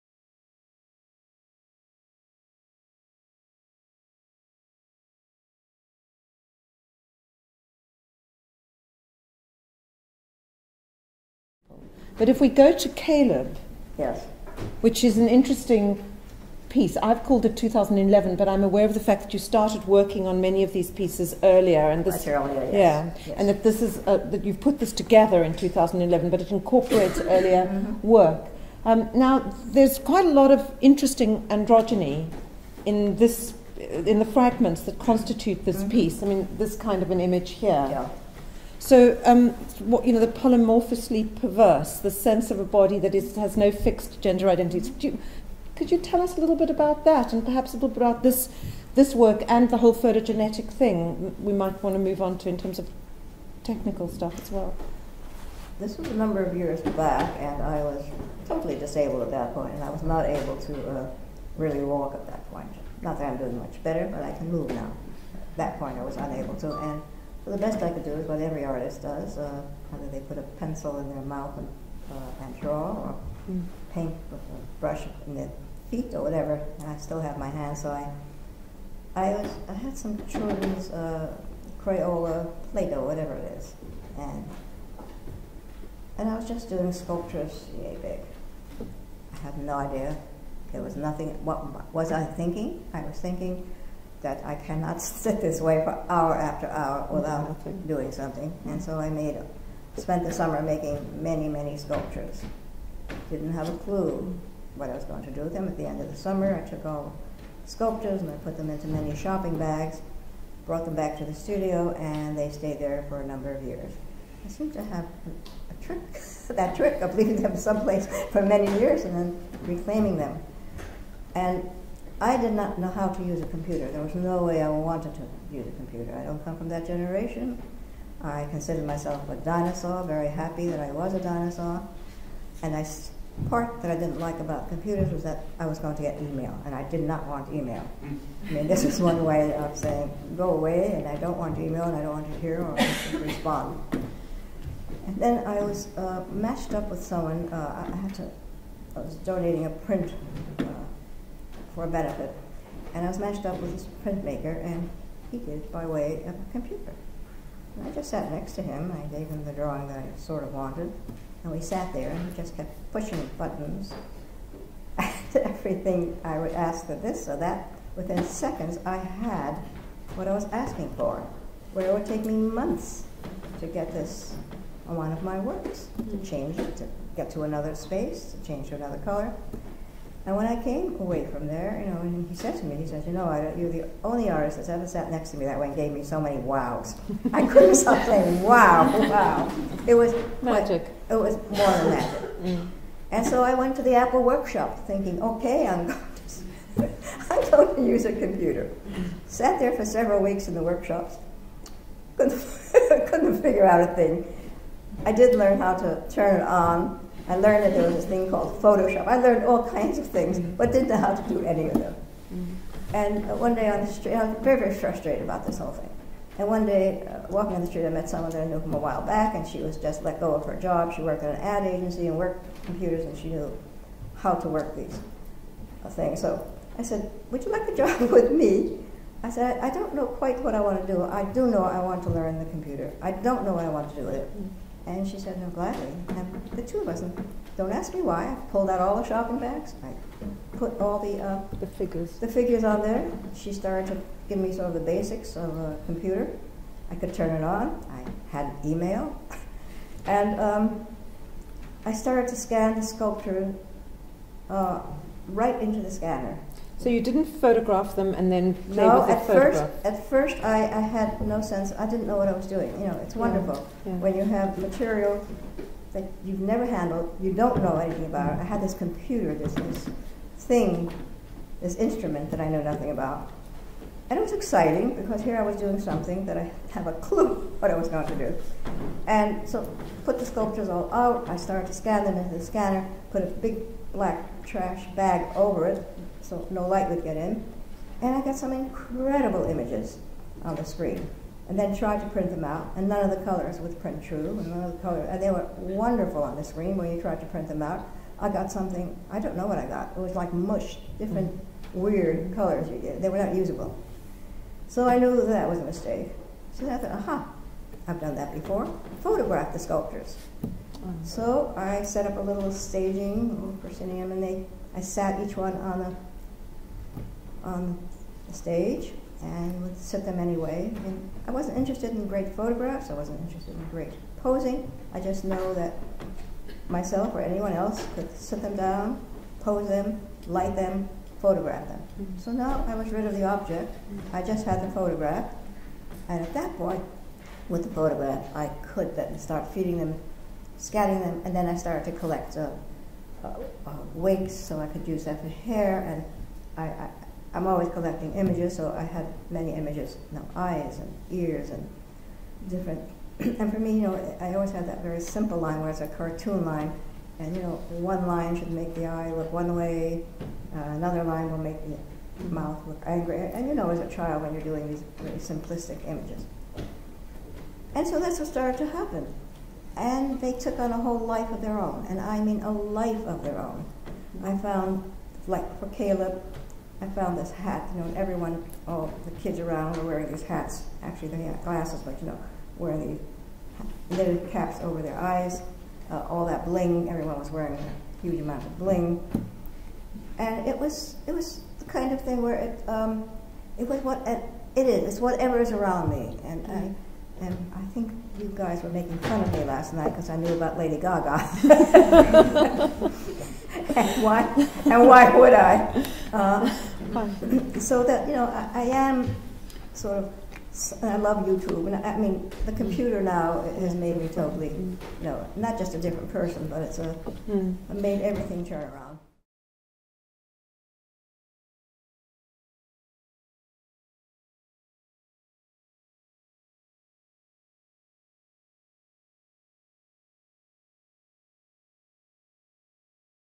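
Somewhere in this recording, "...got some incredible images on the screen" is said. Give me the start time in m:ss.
4:48.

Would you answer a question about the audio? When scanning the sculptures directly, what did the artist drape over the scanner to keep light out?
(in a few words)
A big black trash bag.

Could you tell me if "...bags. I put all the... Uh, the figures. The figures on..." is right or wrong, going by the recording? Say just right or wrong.
right.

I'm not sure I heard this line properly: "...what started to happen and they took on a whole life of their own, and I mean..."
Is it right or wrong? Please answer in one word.
right.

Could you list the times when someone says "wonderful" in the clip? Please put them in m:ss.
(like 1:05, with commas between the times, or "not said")
4:23, 4:55.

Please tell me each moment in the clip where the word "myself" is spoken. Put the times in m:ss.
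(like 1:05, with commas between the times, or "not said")
2:08, 5:26.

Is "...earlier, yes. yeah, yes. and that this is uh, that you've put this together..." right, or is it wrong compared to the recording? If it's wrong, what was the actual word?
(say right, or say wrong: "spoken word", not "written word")
right.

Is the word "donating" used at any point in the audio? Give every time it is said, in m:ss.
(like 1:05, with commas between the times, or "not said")
2:29.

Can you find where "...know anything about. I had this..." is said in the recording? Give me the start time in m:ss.
4:27.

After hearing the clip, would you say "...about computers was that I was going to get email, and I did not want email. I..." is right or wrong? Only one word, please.
right.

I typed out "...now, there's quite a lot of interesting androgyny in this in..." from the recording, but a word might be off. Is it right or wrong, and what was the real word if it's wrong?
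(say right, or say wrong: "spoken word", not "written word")
right.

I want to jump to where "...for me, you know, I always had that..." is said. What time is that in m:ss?
5:53.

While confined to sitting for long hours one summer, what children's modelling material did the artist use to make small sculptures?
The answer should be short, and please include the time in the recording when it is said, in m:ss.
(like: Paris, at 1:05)
Crayola Play-Doh, at 1:21.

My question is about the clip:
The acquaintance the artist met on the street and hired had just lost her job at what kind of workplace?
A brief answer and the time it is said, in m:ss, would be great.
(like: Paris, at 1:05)
An ad agency, at 3:41.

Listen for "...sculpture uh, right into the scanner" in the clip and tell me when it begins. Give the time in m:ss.
4:12.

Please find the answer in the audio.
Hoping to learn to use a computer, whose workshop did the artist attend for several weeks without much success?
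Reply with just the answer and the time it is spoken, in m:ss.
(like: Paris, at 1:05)
Apple, at 3:13.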